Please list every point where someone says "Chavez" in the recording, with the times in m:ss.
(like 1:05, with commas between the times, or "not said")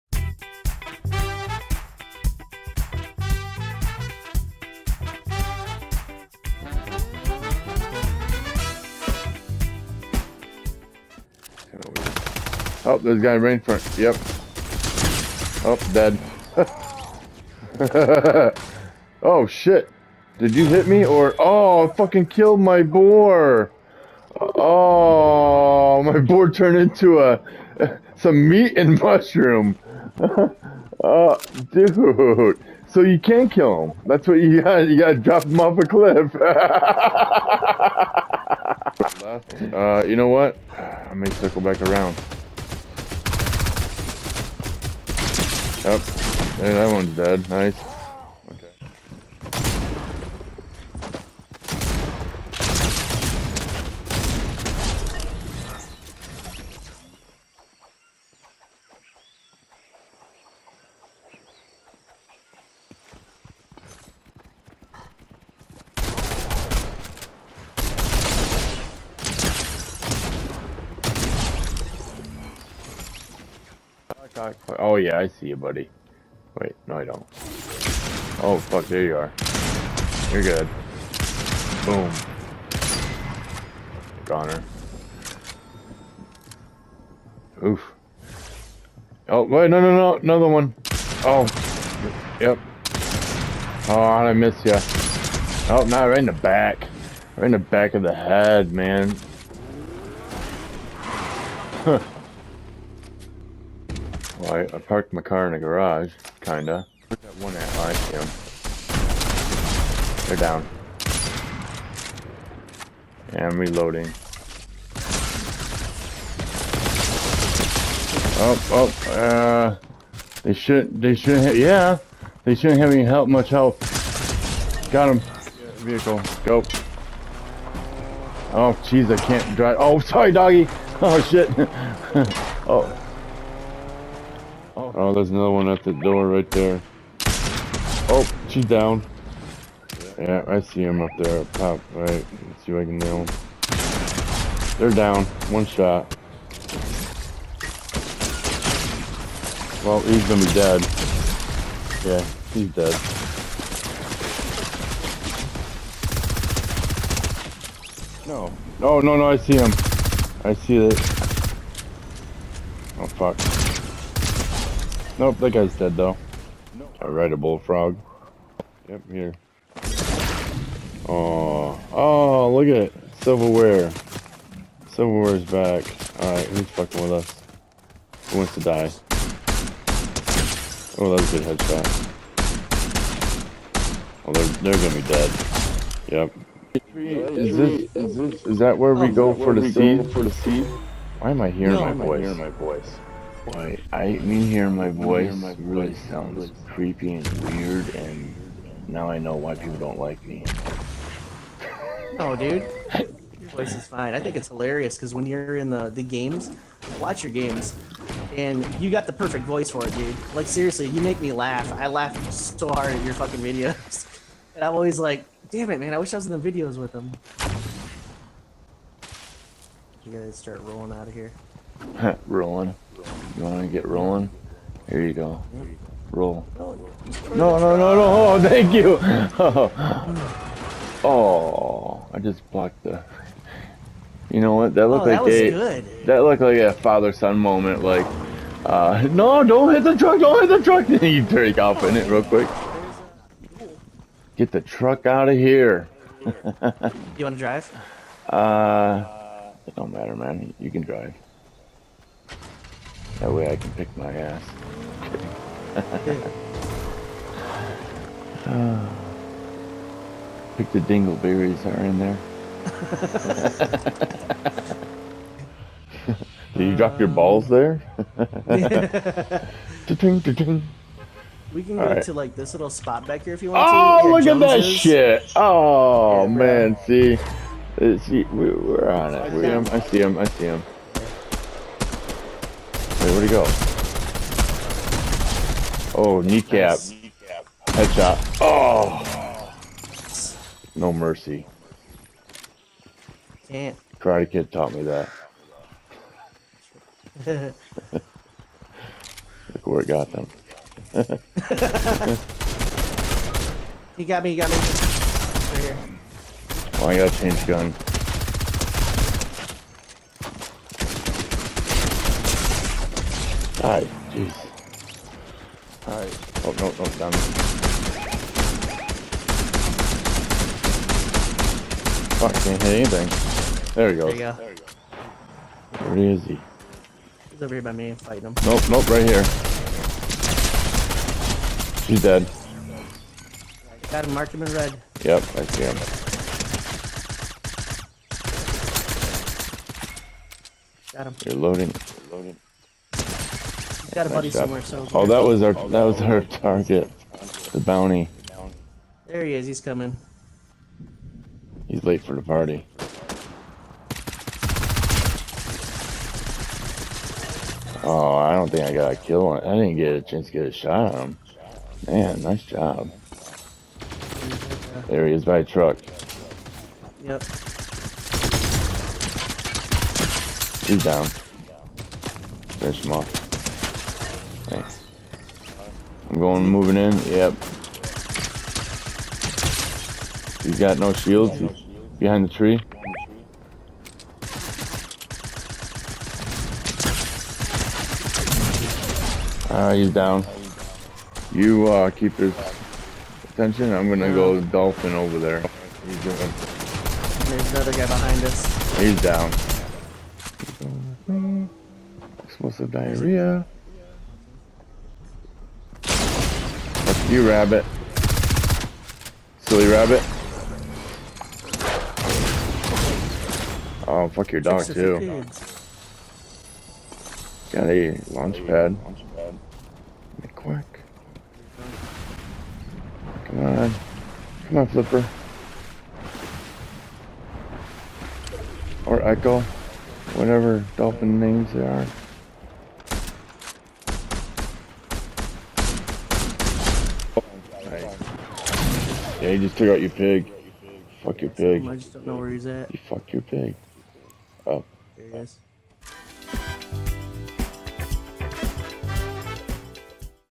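not said.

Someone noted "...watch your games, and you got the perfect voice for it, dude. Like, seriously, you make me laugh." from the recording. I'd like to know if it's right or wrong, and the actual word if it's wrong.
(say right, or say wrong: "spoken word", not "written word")
right.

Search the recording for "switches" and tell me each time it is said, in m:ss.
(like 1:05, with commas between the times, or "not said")
not said.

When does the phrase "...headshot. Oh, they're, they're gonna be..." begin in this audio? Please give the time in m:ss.
3:01.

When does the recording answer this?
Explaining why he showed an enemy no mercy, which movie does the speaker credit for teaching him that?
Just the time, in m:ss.
4:53.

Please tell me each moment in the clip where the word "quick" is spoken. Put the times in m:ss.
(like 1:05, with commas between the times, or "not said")
4:02, 7:00.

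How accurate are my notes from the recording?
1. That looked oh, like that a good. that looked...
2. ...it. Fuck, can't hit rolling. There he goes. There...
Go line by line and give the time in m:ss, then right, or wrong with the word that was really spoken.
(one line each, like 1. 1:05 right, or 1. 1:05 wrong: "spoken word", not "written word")
1. 3:54 right
2. 5:17 wrong: "anything", not "rolling".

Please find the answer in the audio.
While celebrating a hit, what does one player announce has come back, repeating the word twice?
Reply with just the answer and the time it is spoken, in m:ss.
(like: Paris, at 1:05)
Silverware, at 2:54.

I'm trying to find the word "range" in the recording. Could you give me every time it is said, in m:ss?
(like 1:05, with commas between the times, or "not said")
0:13.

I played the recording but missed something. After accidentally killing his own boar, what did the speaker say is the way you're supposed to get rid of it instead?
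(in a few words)
Drop him off a cliff.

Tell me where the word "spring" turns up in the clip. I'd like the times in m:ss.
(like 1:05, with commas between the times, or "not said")
not said.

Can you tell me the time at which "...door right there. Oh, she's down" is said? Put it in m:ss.
2:15.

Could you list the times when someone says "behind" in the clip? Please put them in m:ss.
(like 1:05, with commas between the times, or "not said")
6:21, 6:37.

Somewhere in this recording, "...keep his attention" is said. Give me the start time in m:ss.
6:31.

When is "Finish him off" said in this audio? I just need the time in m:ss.
6:12.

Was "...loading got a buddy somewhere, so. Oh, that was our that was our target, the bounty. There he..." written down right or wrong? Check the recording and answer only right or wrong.
right.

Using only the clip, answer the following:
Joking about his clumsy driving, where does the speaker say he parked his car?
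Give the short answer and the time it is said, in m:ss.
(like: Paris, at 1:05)
garage, at 1:45.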